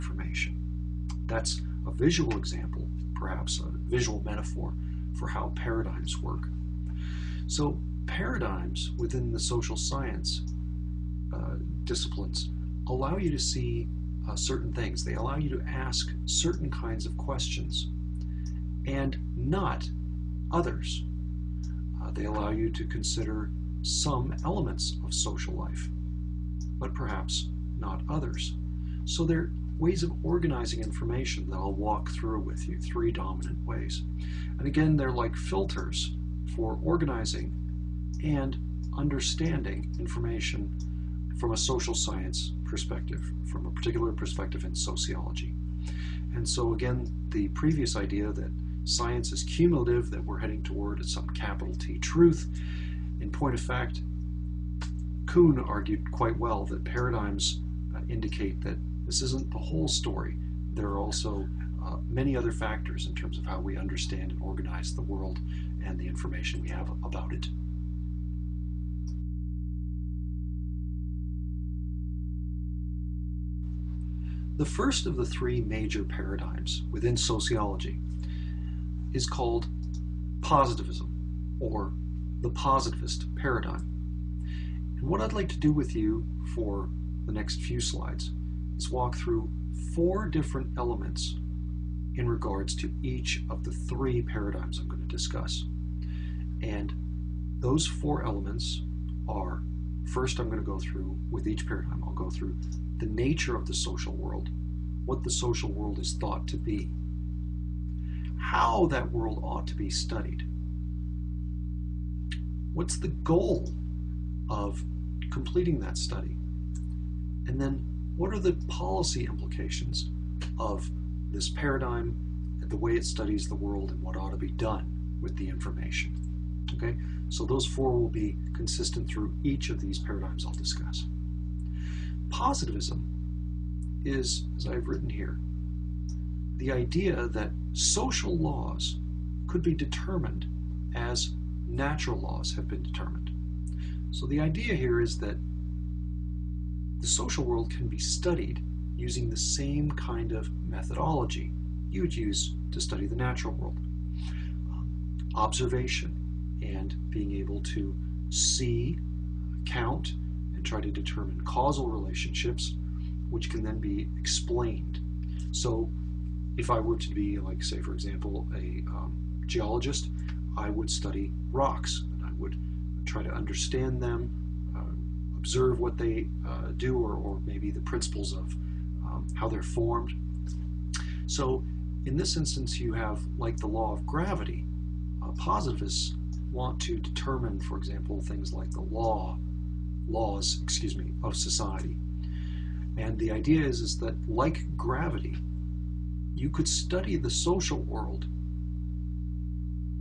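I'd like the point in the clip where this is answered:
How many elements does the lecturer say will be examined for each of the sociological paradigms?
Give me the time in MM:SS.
01:29.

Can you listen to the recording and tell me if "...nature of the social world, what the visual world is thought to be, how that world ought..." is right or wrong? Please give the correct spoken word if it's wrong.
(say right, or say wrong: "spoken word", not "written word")
wrong: "social", not "visual".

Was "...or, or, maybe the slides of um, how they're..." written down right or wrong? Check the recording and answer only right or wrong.
wrong.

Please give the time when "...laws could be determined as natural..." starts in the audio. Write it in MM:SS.
02:18.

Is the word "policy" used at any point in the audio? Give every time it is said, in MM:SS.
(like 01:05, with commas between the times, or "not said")
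01:58.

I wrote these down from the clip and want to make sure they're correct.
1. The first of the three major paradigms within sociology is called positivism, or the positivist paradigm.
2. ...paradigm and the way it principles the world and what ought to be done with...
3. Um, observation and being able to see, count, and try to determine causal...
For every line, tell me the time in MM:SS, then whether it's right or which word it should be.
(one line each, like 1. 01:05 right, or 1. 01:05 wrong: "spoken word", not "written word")
1. 01:14 right
2. 02:01 wrong: "studies", not "principles"
3. 02:34 right.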